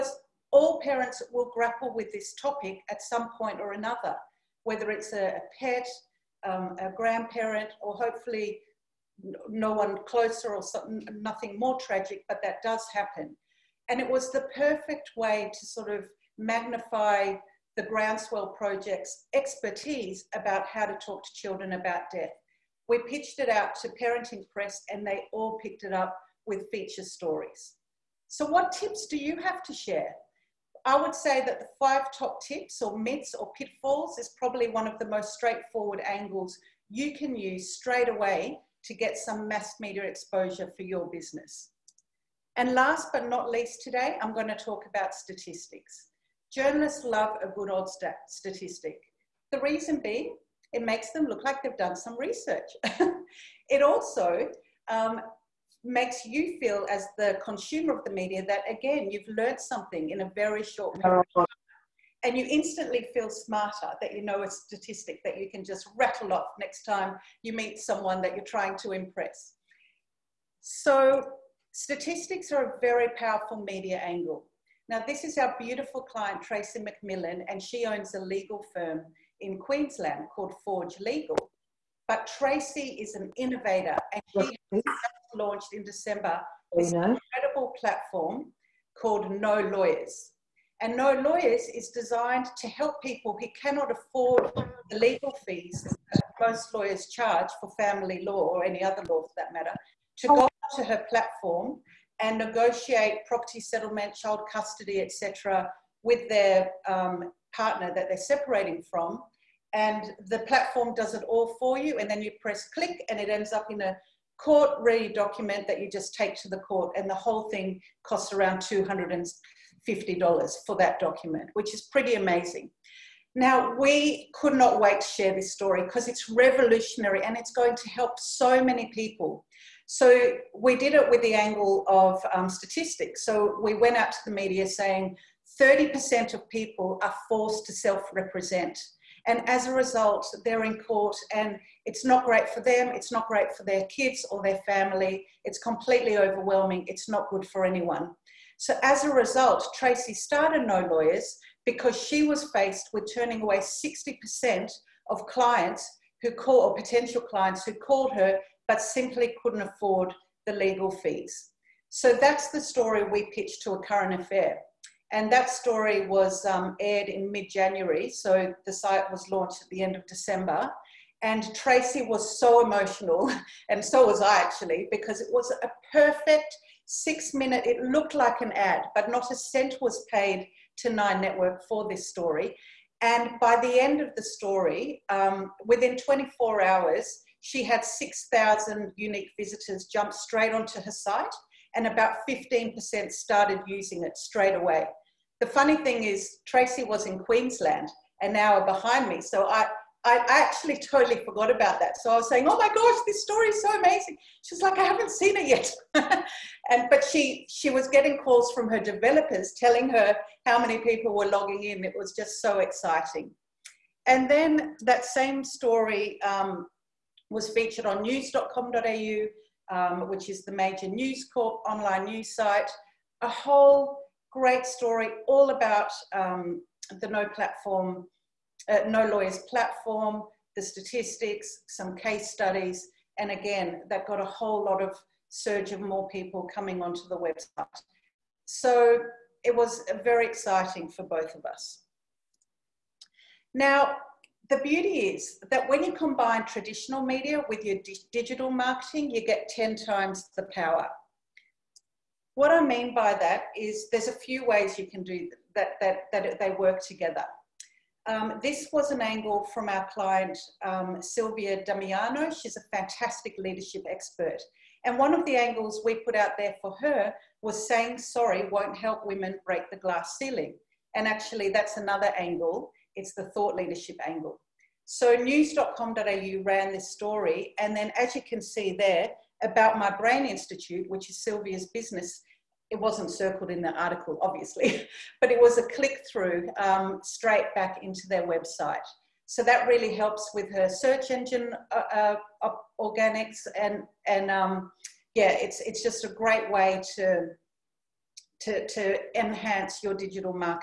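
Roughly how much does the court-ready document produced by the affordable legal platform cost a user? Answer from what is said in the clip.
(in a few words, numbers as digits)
$250.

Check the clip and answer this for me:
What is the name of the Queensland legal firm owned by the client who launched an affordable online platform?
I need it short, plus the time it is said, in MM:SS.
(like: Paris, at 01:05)
Forge Legal, at 01:20.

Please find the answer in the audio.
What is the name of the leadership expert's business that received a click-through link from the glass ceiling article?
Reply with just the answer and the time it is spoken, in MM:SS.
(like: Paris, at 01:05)
my Brain Institute, at 04:39.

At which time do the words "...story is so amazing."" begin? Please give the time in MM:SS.
03:23.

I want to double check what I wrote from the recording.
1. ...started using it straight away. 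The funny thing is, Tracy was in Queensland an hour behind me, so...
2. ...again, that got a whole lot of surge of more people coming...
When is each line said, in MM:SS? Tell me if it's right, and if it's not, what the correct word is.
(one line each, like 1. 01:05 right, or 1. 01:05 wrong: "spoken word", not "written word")
1. 03:13 right
2. 03:53 right.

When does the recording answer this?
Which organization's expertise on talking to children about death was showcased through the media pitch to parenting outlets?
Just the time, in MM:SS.
00:17.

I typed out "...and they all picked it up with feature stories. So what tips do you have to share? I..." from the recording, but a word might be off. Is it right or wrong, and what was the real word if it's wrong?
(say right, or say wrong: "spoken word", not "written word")
right.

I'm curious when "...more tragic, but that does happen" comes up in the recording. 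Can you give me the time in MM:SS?
00:11.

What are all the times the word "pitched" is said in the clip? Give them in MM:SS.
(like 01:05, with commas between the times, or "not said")
00:23, 02:43.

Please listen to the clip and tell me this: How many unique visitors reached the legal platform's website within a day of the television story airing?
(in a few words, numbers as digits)
6,000.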